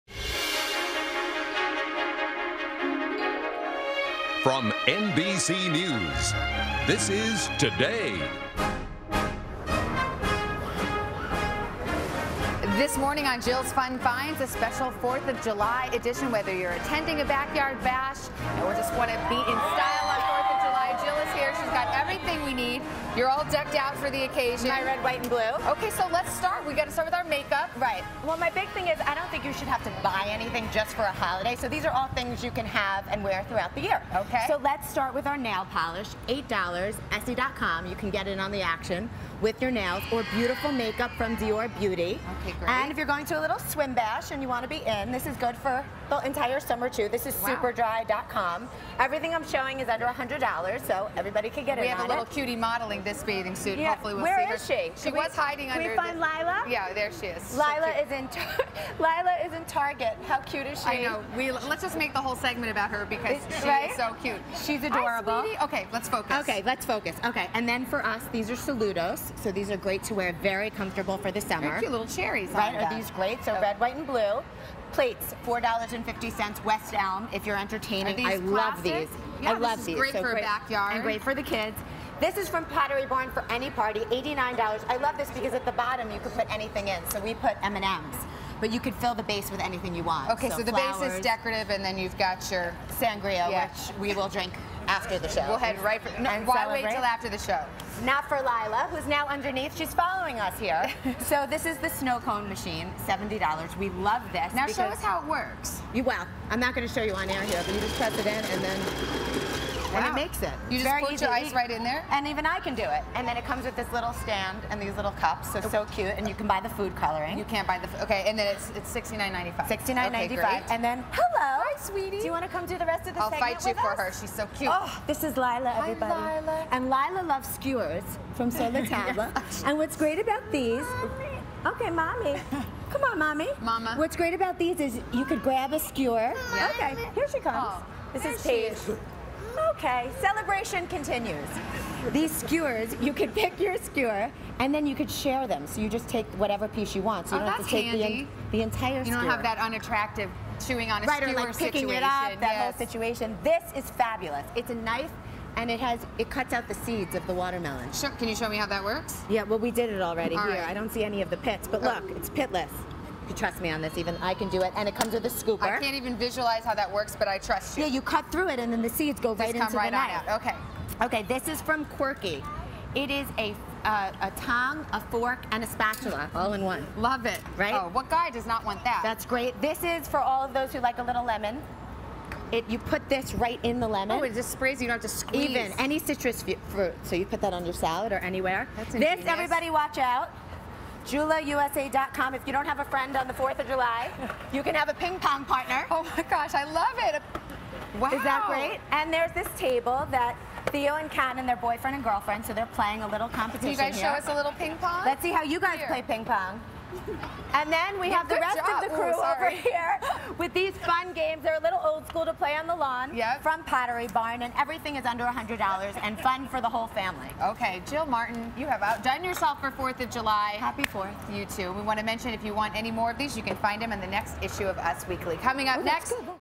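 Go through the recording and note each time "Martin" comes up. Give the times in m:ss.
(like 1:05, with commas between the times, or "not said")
3:38.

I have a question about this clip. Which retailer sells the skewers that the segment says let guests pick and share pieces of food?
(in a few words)
Sur La Table.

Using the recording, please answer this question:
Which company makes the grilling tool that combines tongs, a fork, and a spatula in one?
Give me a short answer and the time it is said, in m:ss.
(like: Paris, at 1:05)
Quirky, at 2:51.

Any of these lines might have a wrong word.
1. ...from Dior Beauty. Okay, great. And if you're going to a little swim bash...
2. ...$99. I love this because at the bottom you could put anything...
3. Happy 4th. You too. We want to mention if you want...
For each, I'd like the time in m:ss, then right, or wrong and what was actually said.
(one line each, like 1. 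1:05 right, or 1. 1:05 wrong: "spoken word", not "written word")
1. 0:41 right
2. 1:24 wrong: "89", not "99"
3. 3:40 right.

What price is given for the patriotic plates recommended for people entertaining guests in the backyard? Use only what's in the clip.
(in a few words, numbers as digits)
$4.50.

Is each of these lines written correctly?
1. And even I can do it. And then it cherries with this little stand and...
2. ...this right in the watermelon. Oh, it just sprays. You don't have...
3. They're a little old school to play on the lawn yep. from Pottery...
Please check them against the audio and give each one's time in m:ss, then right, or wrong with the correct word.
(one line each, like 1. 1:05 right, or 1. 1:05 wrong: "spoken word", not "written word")
1. 1:52 wrong: "comes", not "cherries"
2. 3:03 wrong: "lemon", not "watermelon"
3. 3:31 right.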